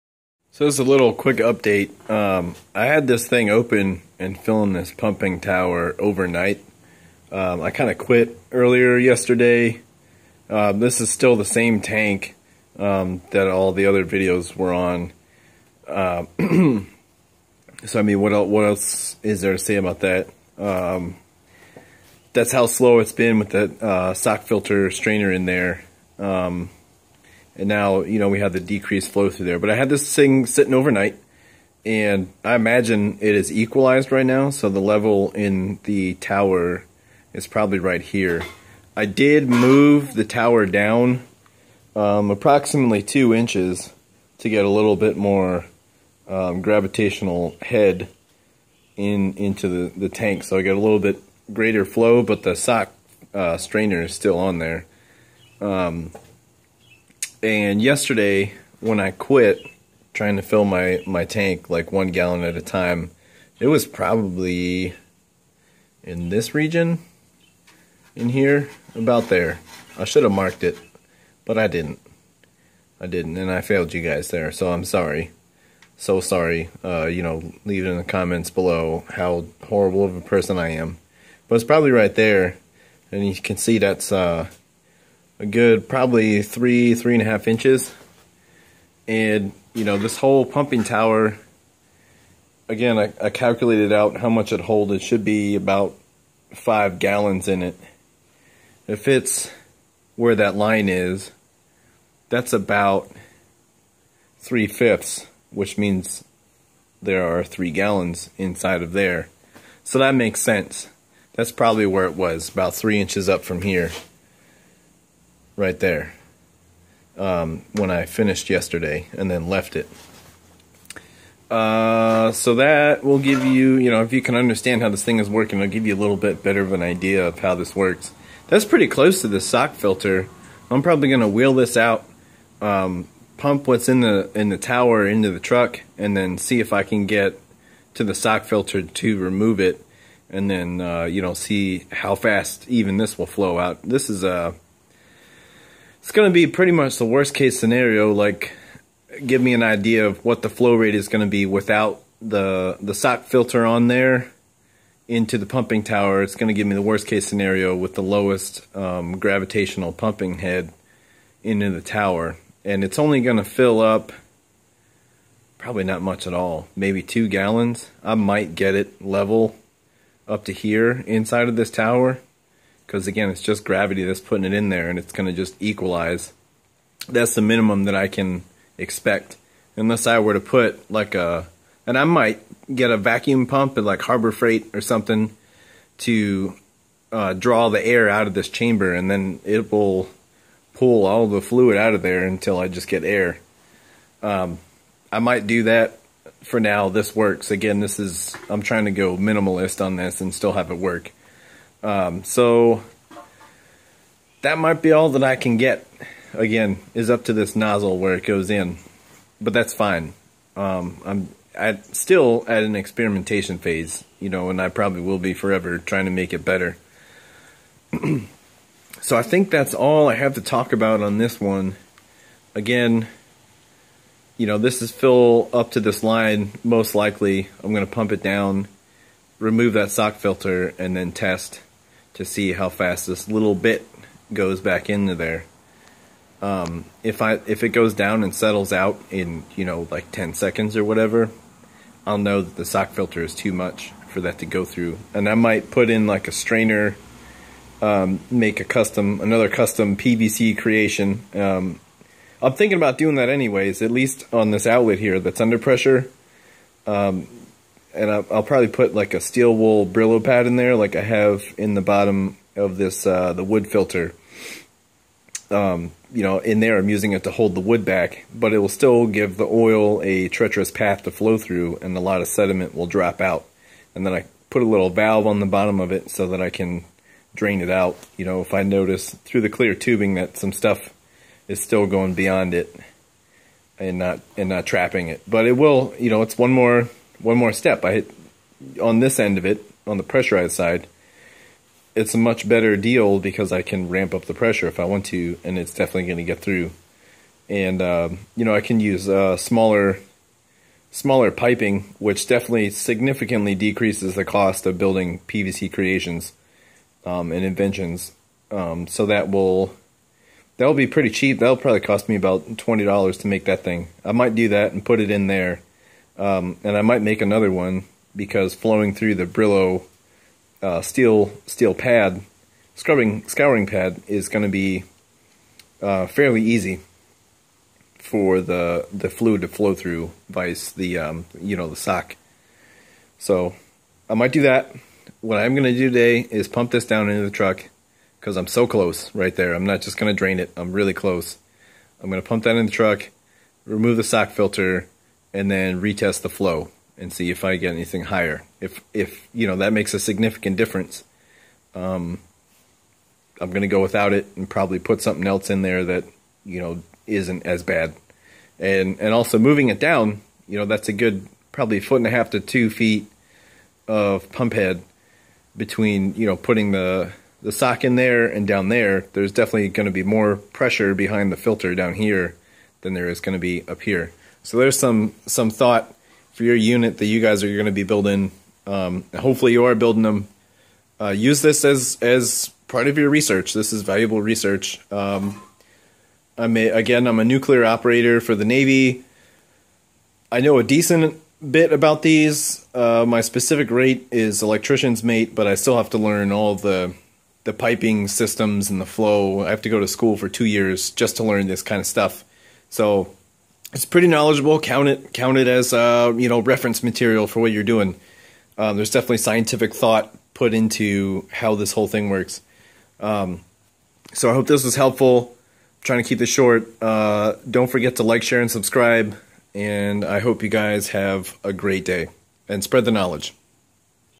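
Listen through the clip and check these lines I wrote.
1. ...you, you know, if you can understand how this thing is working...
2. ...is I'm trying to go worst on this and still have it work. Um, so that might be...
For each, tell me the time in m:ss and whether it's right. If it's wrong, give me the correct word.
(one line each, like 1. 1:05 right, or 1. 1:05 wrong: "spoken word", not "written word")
1. 2:03 right
2. 3:18 wrong: "minimalist", not "worst".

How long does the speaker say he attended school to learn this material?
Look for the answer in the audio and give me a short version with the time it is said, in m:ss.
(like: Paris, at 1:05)
2 years, at 6:40.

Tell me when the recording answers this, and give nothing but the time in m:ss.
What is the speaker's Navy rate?
6:34.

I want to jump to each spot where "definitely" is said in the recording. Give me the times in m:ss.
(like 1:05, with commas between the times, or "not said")
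4:55, 5:02, 6:09, 6:48.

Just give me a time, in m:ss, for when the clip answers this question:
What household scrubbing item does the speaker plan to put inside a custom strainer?
4:19.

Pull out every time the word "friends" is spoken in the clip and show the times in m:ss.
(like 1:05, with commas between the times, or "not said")
not said.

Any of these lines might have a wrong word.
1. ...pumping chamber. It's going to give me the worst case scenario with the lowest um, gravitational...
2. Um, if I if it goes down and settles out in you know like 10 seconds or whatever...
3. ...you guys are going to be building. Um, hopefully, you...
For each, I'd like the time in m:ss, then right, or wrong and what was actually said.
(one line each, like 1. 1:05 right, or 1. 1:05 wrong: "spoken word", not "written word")
1. 2:35 wrong: "tower", not "chamber"
2. 3:56 right
3. 6:17 right.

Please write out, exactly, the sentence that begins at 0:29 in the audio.
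But I had this thing sitting overnight, and I imagine it is equalized right now.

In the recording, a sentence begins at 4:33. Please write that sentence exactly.
And then I put a little valve on the bottom of it so that I can drain it out.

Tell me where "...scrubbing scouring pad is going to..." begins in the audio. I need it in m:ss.
5:22.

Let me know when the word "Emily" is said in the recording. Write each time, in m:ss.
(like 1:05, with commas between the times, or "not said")
not said.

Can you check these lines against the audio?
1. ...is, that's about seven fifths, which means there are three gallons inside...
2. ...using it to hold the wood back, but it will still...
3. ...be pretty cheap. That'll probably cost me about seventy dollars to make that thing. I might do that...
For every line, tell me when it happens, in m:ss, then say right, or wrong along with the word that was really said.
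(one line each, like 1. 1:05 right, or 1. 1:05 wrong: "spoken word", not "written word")
1. 1:40 wrong: "three", not "seven"
2. 4:26 right
3. 5:10 wrong: "twenty", not "seventy".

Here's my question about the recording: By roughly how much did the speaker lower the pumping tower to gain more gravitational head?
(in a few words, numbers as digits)
2 inches.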